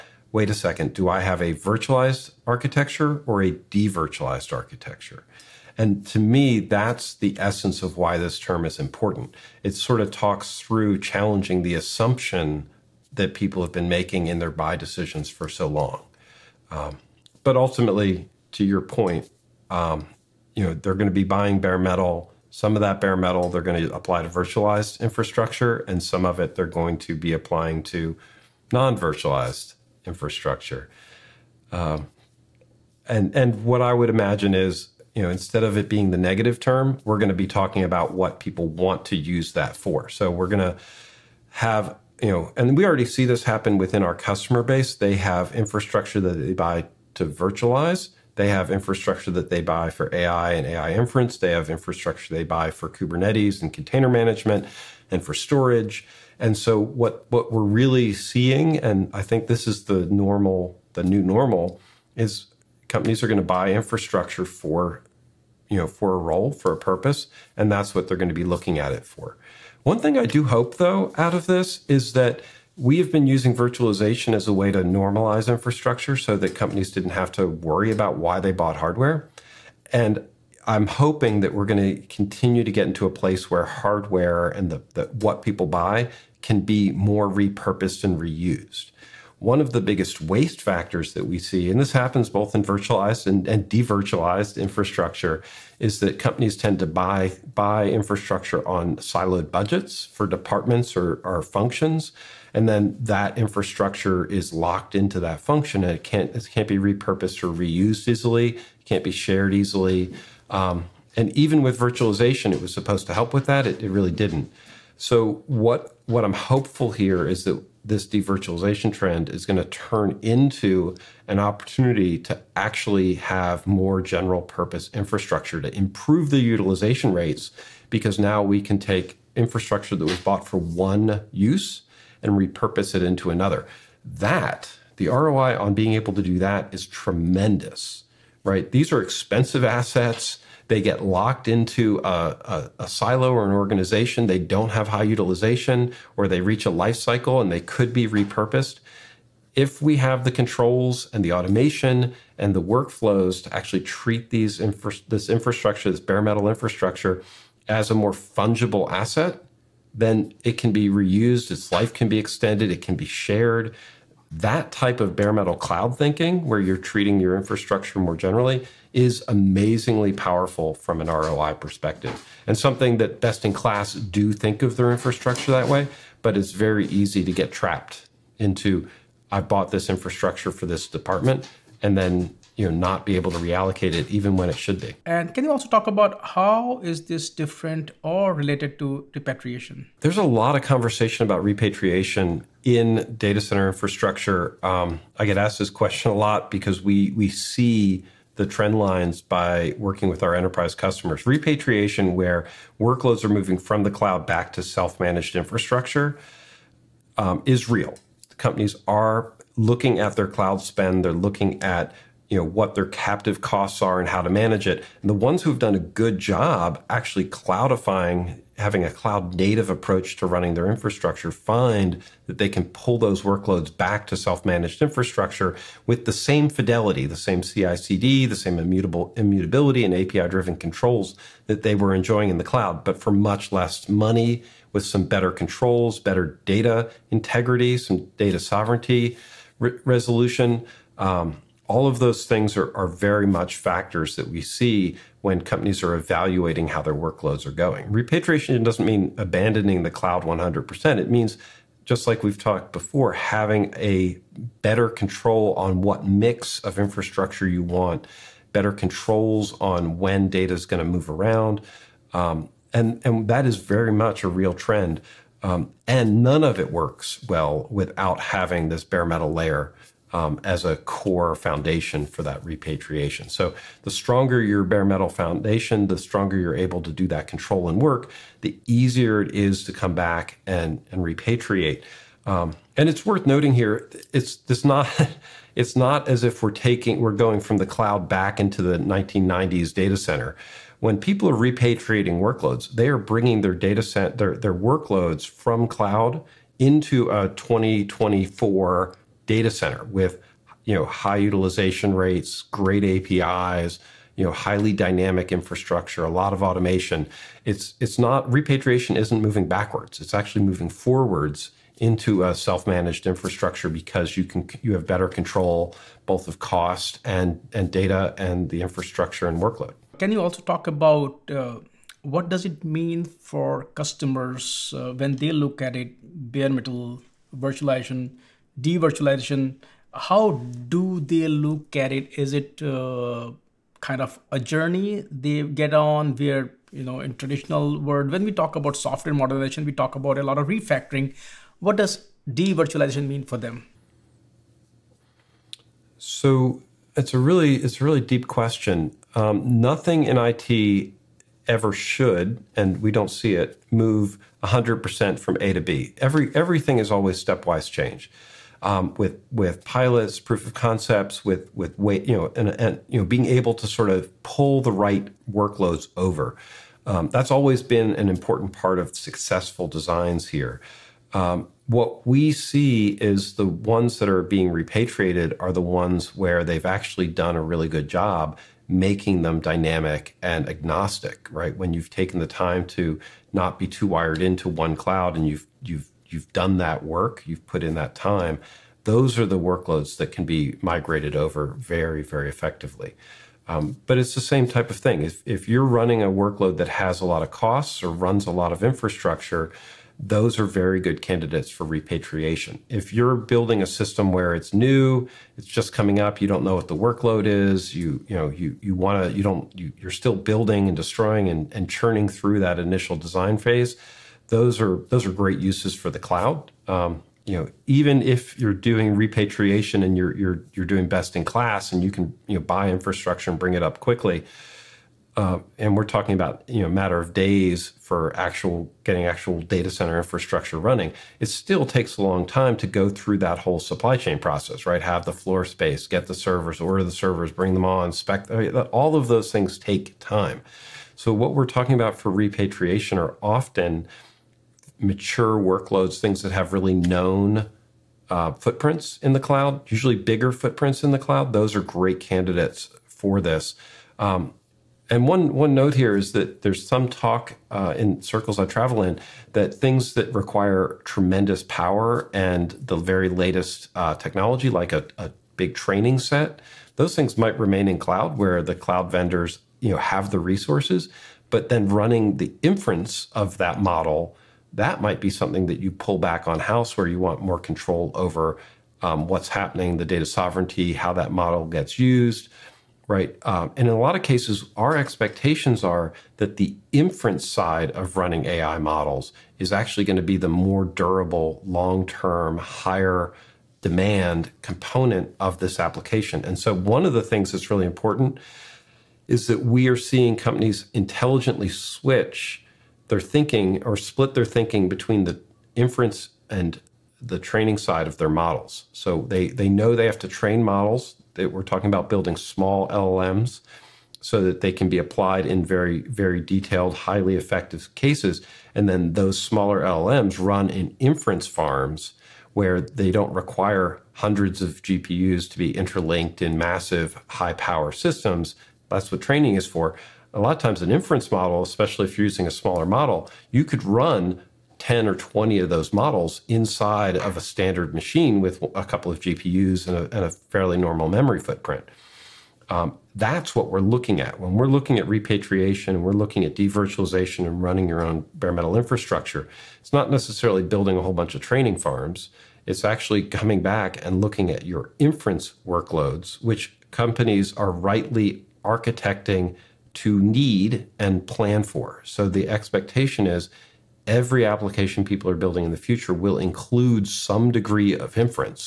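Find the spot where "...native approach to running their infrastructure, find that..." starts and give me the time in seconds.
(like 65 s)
219 s.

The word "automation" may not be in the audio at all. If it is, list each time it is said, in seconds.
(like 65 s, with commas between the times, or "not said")
151 s, 306 s.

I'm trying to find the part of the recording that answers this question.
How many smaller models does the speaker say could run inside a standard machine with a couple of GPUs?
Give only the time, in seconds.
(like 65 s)
534 s.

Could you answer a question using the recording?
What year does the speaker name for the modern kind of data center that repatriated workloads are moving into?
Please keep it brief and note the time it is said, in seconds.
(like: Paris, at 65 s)
2024, at 297 s.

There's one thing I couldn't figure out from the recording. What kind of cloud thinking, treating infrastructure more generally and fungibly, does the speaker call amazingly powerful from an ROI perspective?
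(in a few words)
bare metal cloud.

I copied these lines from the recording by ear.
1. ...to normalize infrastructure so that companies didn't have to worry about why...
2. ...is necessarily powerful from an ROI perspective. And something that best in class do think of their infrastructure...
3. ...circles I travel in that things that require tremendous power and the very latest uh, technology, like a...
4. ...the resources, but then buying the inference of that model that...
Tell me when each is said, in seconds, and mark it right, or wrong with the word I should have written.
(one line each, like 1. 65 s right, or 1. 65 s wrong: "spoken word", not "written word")
1. 74 s right
2. 168 s wrong: "amazingly", not "necessarily"
3. 458 s right
4. 470 s wrong: "running", not "buying".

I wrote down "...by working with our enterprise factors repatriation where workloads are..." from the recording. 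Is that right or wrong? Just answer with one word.
wrong.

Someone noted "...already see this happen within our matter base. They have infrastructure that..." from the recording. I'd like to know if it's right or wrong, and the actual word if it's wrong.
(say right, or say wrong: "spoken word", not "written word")
wrong: "customer", not "matter".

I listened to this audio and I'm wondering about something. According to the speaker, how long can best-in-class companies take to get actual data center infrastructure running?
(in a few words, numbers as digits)
matter of days.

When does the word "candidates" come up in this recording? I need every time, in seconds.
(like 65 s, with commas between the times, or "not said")
401 s, 451 s.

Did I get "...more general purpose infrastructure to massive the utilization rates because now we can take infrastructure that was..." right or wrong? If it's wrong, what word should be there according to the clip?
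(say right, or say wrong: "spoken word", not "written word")
wrong: "improve", not "massive".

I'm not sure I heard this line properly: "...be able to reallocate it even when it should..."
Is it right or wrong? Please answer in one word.
right.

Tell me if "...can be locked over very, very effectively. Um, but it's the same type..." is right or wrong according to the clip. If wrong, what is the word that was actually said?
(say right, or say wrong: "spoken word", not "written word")
wrong: "migrated", not "locked".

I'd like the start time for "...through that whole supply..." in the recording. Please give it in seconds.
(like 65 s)
432 s.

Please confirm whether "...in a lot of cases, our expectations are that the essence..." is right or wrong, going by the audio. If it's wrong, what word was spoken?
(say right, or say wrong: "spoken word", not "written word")
wrong: "inference", not "essence".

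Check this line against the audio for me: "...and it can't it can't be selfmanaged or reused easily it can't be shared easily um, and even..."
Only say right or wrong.
wrong.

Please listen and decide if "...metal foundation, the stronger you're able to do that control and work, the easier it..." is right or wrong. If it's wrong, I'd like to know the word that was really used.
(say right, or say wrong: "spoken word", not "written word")
right.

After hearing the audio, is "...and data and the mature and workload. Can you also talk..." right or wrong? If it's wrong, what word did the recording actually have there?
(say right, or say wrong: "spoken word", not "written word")
wrong: "infrastructure", not "mature".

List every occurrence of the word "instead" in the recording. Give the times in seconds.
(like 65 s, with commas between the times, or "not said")
35 s.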